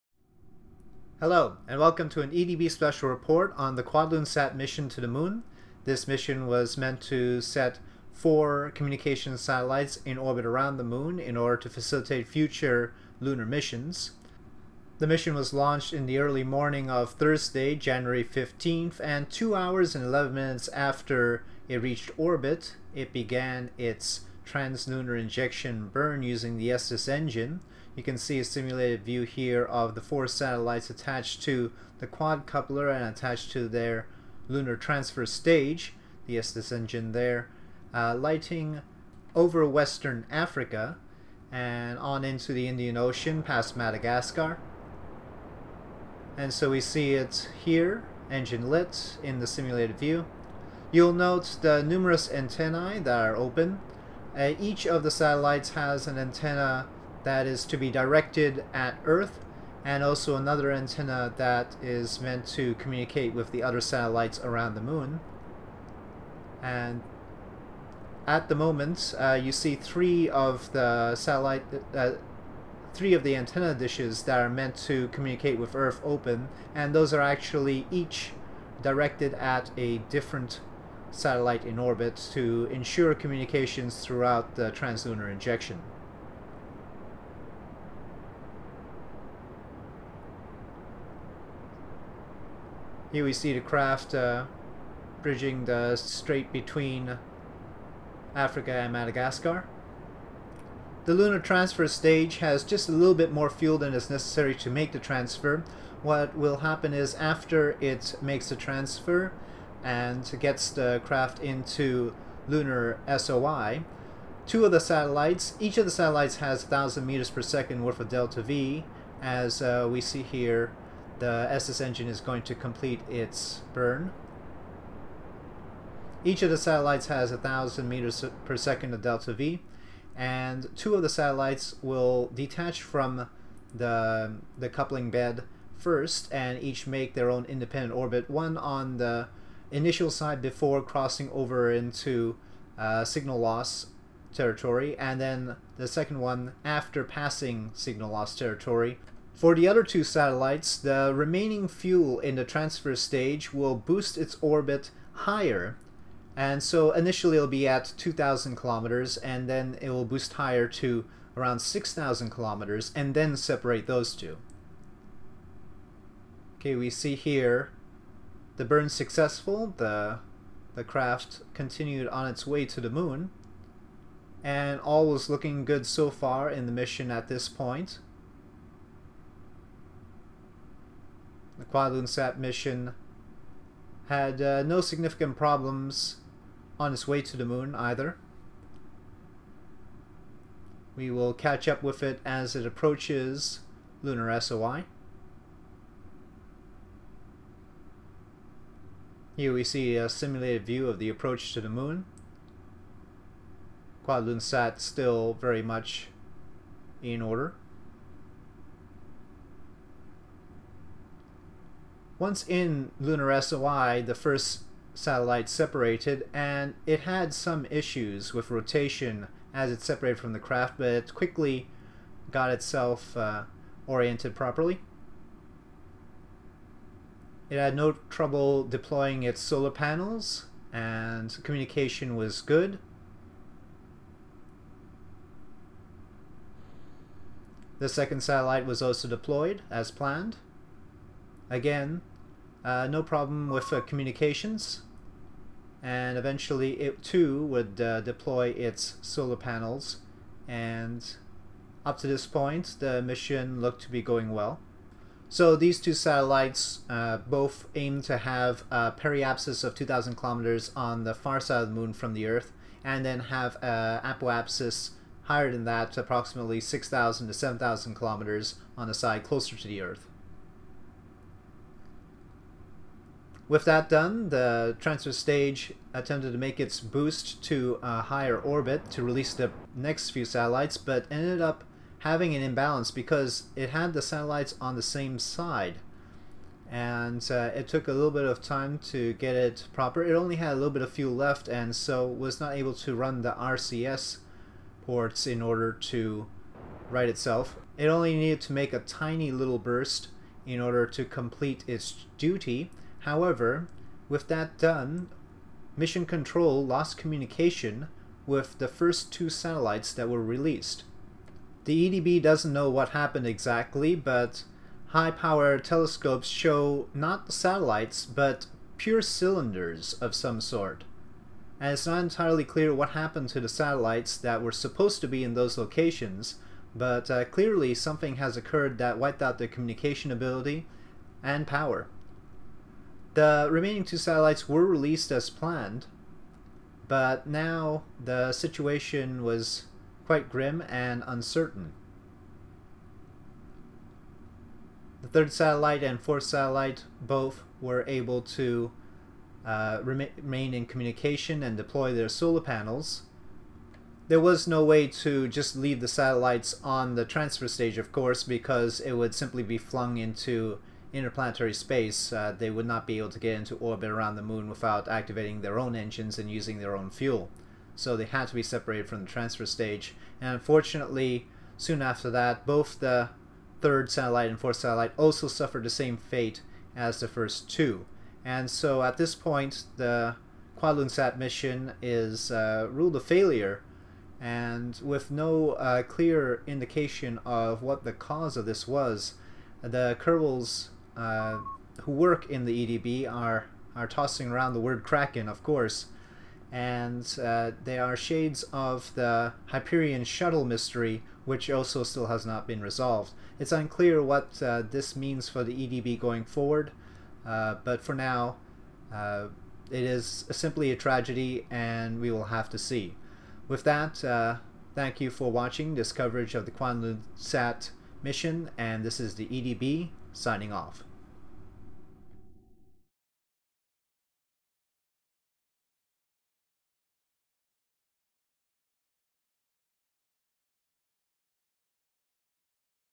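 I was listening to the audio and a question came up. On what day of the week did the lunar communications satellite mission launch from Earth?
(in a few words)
Thursday.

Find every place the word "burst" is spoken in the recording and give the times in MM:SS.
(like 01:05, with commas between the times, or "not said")
04:59.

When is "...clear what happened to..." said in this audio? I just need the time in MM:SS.
05:22.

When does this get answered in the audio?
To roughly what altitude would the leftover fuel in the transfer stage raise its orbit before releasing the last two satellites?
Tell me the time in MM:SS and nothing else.
02:41.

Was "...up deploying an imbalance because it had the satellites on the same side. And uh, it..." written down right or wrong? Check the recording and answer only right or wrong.
wrong.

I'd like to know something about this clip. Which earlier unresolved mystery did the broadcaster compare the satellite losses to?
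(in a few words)
Hyperion shuttle mystery.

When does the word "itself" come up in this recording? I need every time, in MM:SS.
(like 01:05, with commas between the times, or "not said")
03:42, 04:57.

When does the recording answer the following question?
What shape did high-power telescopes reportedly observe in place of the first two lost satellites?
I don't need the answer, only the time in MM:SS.
05:19.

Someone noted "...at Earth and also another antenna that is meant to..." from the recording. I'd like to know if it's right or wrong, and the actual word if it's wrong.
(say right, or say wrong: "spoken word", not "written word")
right.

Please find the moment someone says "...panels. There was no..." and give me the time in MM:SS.
05:52.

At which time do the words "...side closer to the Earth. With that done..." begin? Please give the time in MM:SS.
04:28.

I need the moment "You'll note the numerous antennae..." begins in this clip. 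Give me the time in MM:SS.
00:50.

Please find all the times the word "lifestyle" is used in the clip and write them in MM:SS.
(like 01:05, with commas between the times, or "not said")
not said.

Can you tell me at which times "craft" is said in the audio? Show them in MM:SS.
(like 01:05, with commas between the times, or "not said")
01:33, 01:51, 02:50, 03:40.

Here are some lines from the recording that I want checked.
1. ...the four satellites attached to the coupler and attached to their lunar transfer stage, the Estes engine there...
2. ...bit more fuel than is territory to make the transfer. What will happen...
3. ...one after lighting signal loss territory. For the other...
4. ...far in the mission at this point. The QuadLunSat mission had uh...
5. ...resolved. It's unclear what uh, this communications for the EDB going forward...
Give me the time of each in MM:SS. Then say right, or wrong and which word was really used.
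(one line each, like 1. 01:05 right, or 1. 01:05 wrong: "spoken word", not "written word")
1. 00:29 right
2. 01:43 wrong: "necessary", not "territory"
3. 02:26 wrong: "passing", not "lighting"
4. 02:56 right
5. 06:42 wrong: "means", not "communications".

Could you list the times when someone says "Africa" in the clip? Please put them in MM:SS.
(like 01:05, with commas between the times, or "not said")
00:40, 01:38.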